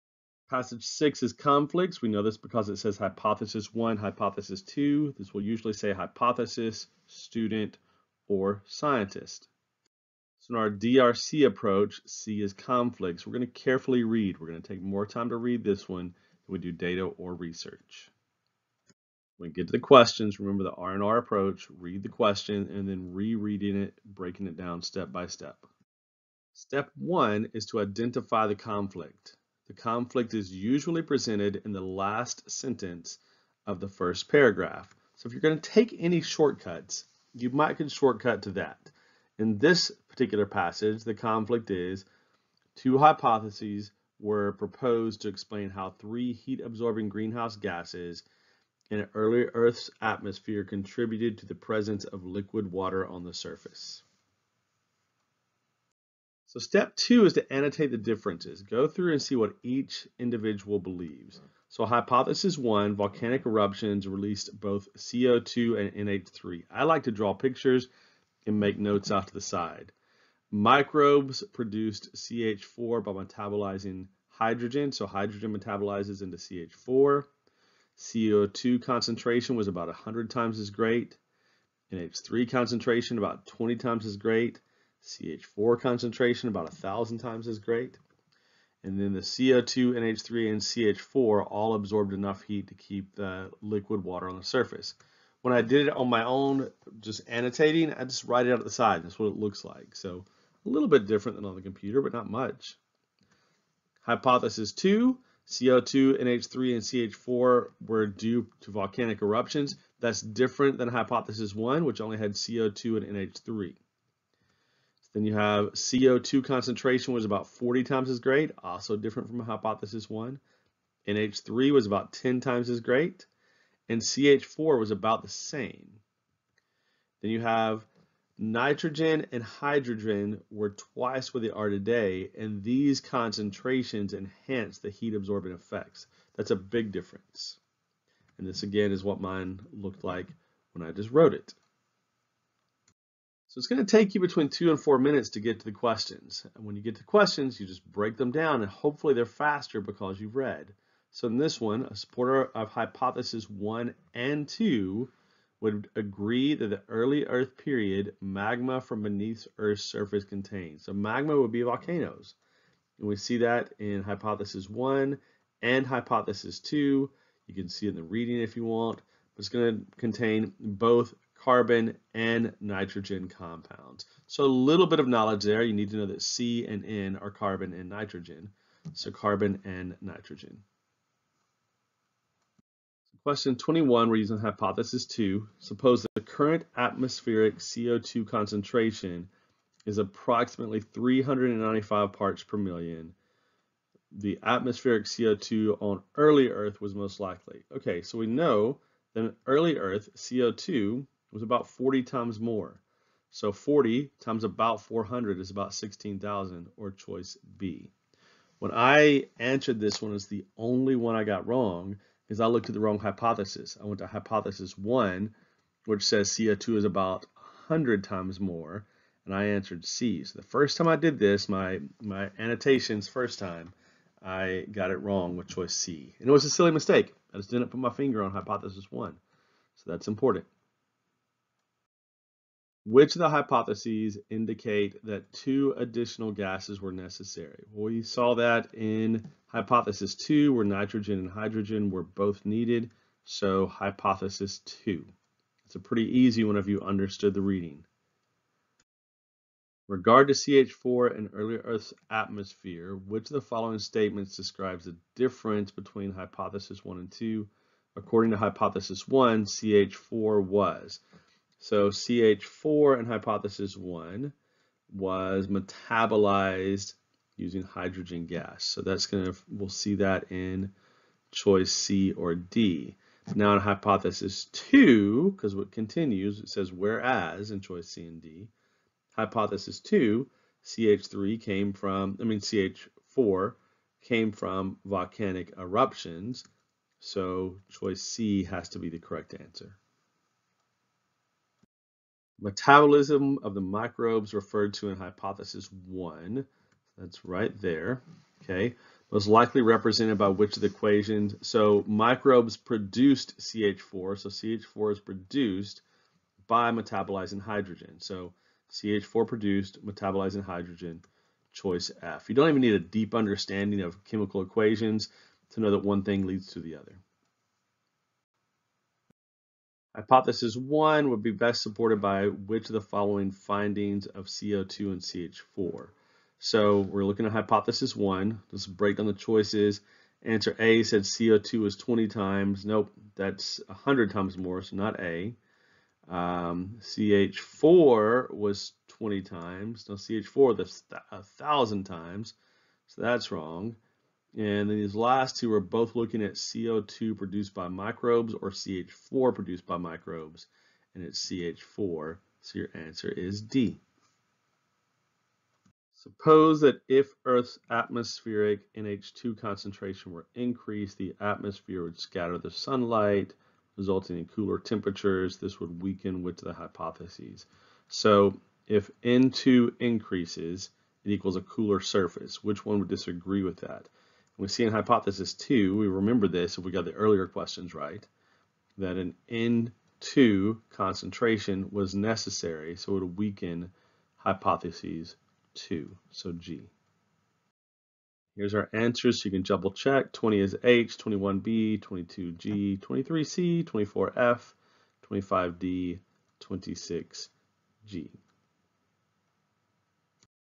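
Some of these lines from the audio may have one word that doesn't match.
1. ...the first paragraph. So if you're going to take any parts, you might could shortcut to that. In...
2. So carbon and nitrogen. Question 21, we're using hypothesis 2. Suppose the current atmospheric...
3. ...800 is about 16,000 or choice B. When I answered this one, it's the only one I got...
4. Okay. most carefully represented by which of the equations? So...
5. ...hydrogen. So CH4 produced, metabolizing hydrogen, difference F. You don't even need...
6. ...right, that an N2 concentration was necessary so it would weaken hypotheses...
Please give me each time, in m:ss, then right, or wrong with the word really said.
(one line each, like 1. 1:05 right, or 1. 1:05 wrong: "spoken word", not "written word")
1. 0:33 wrong: "shortcuts", not "parts"
2. 2:58 right
3. 3:24 wrong: "400", not "800"
4. 4:58 wrong: "likely", not "carefully"
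5. 5:07 wrong: "choice", not "difference"
6. 6:17 right.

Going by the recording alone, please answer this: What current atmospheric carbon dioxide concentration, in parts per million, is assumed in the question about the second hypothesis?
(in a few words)
395.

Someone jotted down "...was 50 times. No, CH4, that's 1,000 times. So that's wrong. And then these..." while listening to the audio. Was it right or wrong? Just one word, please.
wrong.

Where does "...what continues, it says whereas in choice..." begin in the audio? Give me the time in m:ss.
4:35.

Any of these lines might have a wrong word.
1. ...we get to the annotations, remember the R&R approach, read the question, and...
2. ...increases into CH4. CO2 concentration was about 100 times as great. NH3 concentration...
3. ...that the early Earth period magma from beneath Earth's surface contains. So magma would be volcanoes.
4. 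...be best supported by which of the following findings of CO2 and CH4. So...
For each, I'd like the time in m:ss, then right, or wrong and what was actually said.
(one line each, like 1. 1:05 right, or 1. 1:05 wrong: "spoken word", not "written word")
1. 0:19 wrong: "questions", not "annotations"
2. 1:15 wrong: "metabolizes", not "increases"
3. 2:36 right
4. 5:21 right.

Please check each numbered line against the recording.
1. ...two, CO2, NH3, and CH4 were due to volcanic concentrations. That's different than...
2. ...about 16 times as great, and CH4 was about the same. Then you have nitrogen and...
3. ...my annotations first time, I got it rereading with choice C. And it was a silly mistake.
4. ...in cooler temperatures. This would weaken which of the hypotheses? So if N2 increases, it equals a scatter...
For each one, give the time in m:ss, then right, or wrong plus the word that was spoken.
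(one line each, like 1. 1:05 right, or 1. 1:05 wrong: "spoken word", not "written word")
1. 1:44 wrong: "eruptions", not "concentrations"
2. 2:01 wrong: "10", not "16"
3. 3:42 wrong: "wrong", not "rereading"
4. 6:04 wrong: "cooler", not "scatter".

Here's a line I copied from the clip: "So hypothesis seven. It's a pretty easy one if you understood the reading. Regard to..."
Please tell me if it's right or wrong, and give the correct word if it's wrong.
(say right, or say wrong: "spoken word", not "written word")
wrong: "two", not "seven".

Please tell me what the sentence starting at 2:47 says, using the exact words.
You can see it in the reading if you want, but it's going to contain both carbon, and nitrogen compounds.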